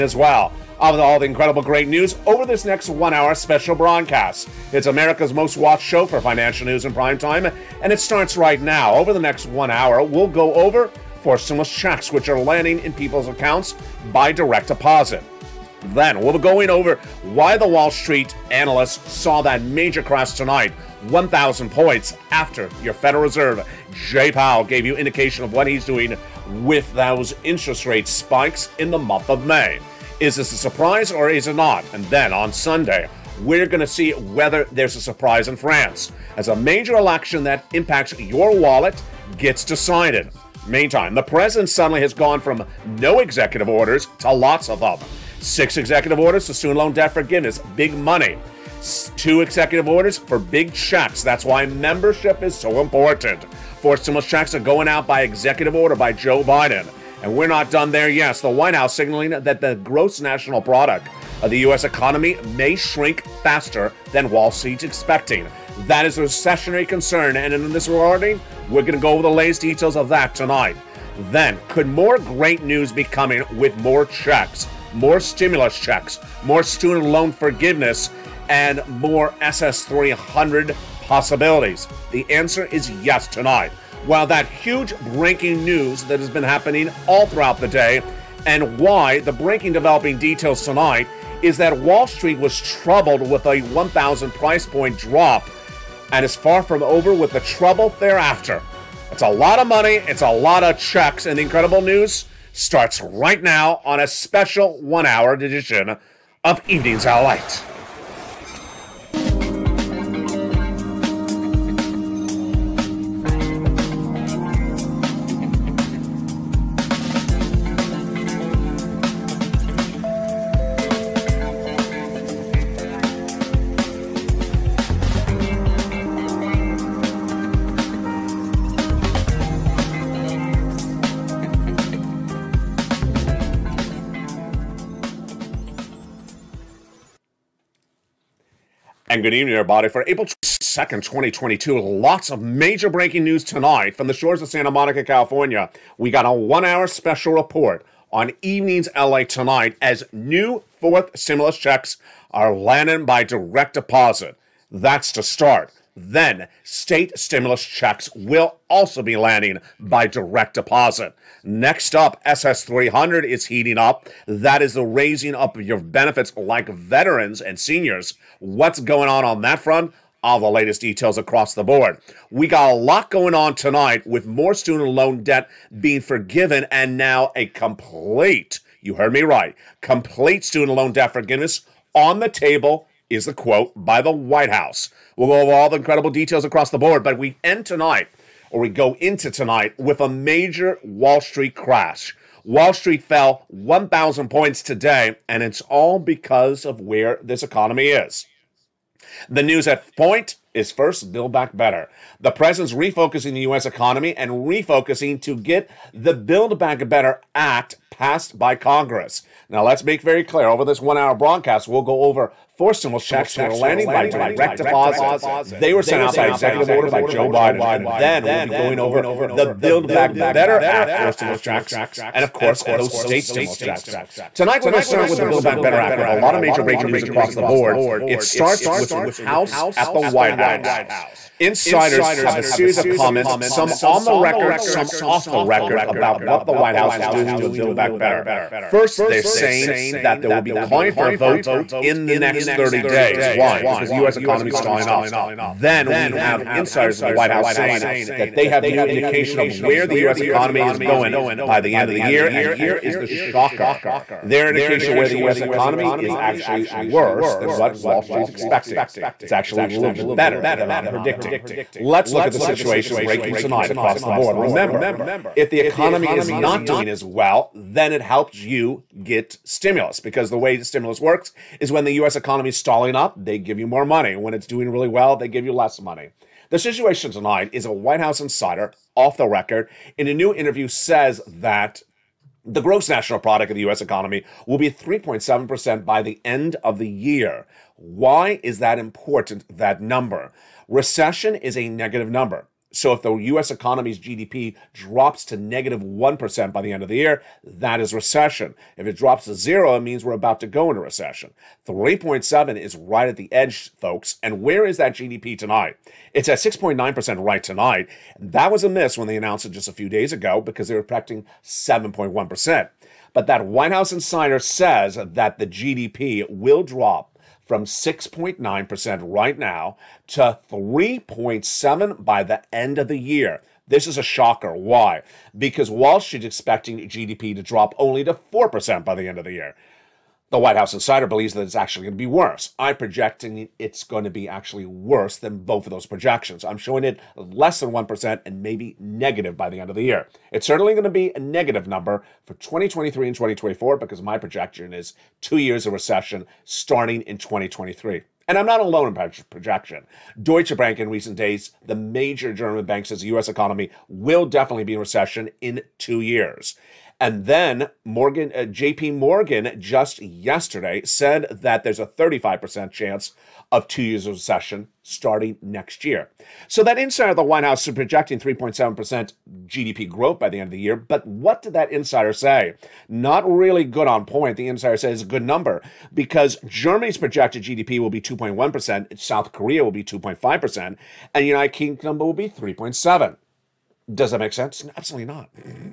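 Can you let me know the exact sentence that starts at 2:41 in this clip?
Next up, SS300 is heating up.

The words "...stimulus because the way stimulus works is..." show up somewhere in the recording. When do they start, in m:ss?
4:29.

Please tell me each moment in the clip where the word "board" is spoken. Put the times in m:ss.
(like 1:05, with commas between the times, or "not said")
2:51, 3:06, 3:47, 4:24.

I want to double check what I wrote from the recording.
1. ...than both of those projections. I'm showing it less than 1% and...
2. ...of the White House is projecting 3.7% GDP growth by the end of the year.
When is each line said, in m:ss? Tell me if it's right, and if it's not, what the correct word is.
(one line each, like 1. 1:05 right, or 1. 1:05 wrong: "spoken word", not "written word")
1. 5:35 right
2. 6:07 right.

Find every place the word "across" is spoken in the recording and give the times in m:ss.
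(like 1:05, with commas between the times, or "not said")
2:51, 3:06, 3:47, 4:23.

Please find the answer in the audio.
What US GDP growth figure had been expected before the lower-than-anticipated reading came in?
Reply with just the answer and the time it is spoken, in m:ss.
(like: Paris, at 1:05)
7.1%, at 5:11.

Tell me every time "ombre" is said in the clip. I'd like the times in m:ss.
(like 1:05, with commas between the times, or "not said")
not said.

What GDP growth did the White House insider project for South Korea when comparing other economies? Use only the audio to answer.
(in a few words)
2.5%.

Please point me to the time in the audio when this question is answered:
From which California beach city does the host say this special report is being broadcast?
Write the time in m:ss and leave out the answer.
2:24.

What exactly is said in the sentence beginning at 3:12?
Wall Street fell 1,000 points today, and it's all because of where this economy is.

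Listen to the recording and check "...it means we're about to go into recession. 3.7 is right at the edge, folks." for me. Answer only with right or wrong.
right.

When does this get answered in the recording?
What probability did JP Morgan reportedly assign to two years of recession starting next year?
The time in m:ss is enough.
6:01.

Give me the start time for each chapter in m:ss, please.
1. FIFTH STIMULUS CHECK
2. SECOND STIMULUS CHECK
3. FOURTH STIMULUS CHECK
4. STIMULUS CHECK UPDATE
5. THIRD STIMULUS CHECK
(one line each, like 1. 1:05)
1. 4:07
2. 1:07
3. 3:07
4. 0:07
5. 2:07.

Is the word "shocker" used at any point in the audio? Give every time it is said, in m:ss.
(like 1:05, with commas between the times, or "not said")
4:13, 5:24.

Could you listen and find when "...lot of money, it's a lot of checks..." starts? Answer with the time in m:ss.
1:39.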